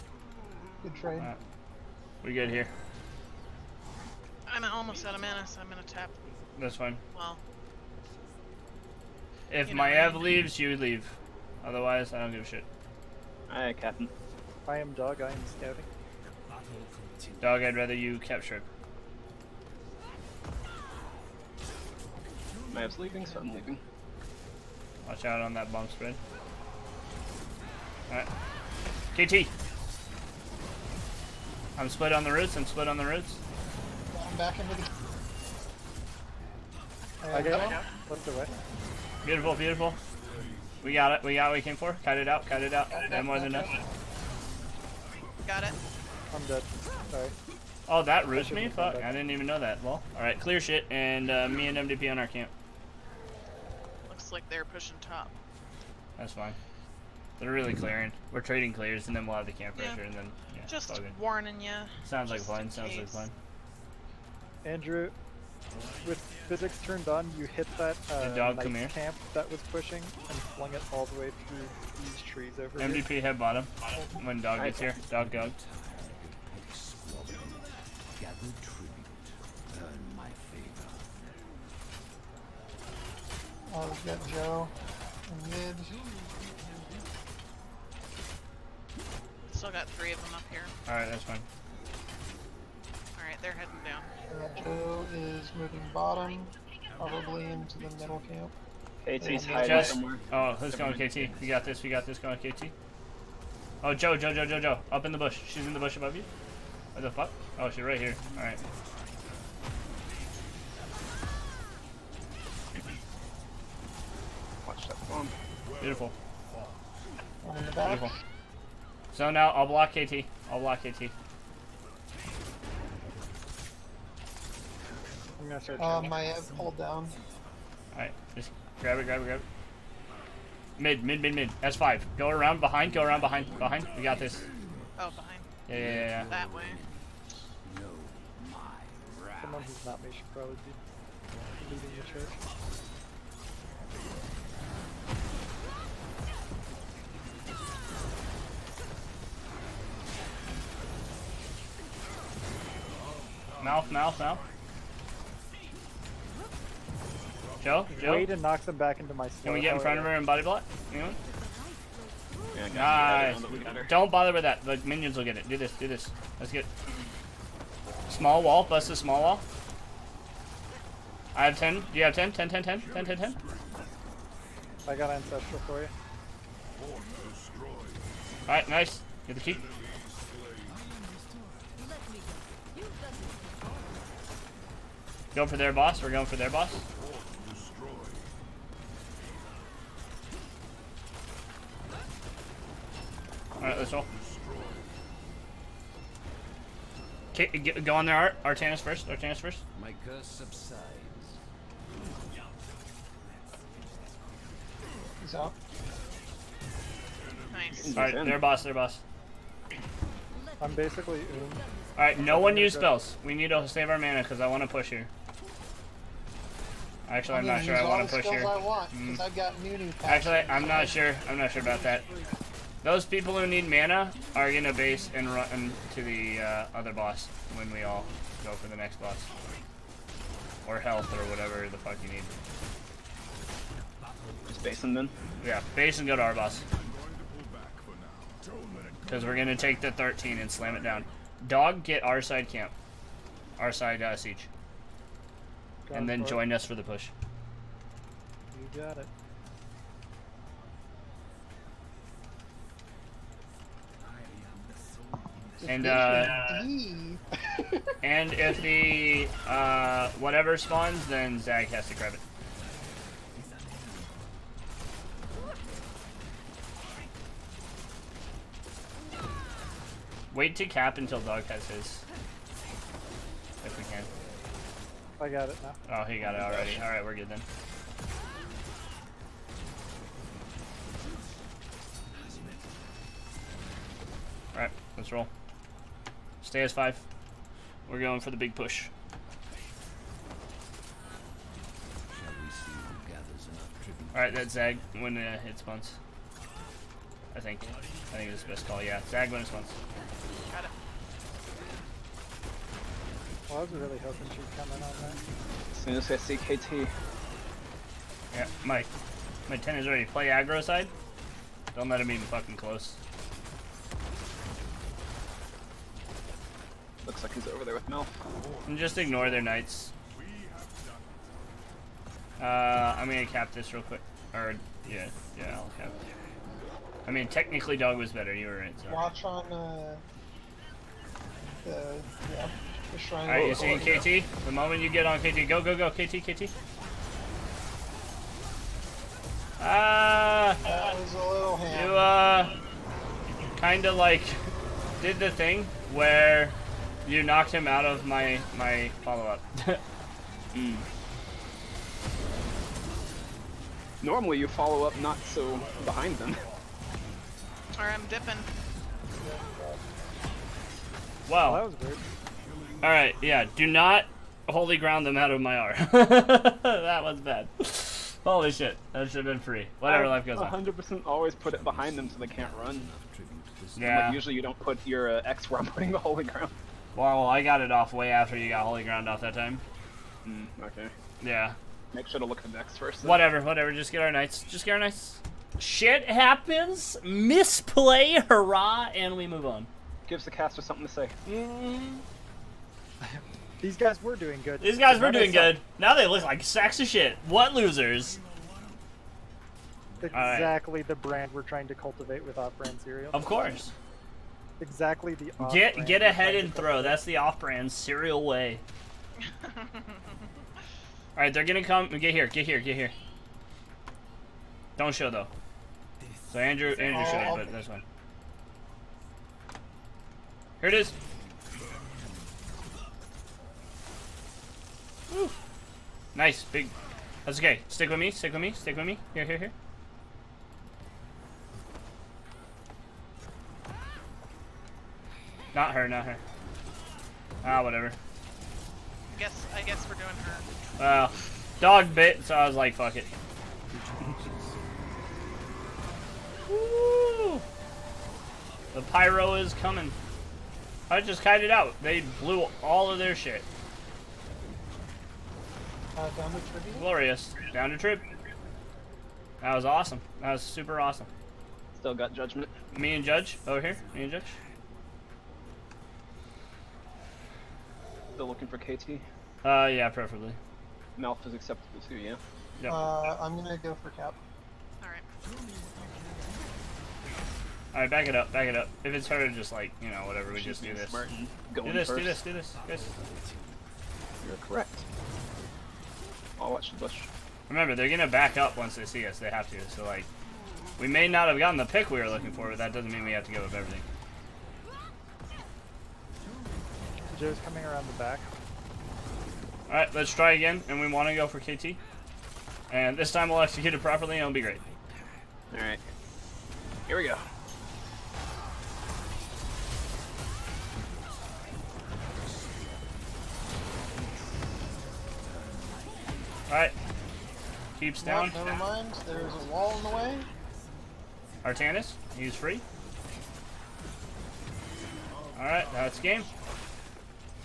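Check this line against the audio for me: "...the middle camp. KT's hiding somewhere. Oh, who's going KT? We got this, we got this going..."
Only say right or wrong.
right.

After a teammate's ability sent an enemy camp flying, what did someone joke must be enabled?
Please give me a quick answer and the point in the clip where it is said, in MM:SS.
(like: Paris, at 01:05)
physics turned on, at 01:06.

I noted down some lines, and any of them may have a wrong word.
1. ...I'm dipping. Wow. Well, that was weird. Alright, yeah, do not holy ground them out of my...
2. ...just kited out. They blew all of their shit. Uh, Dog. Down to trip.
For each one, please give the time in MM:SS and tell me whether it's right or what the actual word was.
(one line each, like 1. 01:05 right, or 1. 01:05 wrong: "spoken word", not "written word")
1. 05:57 right
2. 07:31 wrong: "Glorious", not "Dog".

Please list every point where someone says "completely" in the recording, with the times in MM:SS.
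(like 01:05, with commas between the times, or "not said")
not said.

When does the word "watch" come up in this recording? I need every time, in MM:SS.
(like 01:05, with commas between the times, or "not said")
00:25, 05:28, 08:06.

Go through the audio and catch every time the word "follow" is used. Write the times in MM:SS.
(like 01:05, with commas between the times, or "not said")
05:49, 05:54.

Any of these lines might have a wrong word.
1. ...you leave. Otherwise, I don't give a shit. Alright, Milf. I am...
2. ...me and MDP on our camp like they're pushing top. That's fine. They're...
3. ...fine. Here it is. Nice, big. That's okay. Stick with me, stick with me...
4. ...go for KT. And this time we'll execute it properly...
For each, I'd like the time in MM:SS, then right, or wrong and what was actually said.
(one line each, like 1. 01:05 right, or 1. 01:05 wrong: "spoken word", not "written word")
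1. 00:10 wrong: "Captain", not "Milf"
2. 00:51 right
3. 06:57 right
4. 08:21 right.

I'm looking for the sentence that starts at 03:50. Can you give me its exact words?
Or health or whatever the fuck you need.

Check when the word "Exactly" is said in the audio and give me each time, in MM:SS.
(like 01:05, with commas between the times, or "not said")
06:40, 06:44.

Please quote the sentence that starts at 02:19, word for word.
Someone who's not me should probably be the church.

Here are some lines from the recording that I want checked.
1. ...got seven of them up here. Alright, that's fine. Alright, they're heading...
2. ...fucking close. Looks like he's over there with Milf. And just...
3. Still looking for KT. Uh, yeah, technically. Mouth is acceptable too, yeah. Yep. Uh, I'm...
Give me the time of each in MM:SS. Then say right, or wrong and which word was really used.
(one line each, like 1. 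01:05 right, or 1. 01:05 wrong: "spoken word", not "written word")
1. 01:29 wrong: "three", not "seven"
2. 05:12 right
3. 07:48 wrong: "preferably", not "technically".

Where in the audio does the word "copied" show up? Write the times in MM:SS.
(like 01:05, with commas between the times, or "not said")
not said.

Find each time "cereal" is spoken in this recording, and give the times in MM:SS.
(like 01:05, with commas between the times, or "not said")
06:42, 06:47.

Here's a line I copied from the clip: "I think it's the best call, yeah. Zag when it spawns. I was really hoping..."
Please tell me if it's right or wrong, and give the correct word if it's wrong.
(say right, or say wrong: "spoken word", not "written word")
right.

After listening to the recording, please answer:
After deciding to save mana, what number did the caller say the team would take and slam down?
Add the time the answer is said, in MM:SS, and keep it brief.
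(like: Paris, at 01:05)
13, at 03:59.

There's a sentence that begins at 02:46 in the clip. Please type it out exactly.
Let's get Small wall, bust the small wall.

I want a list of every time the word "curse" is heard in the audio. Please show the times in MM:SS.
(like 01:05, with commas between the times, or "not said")
03:20.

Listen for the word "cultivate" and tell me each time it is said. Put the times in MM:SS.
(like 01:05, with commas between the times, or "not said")
06:41.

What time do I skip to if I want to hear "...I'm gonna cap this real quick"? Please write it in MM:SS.
05:22.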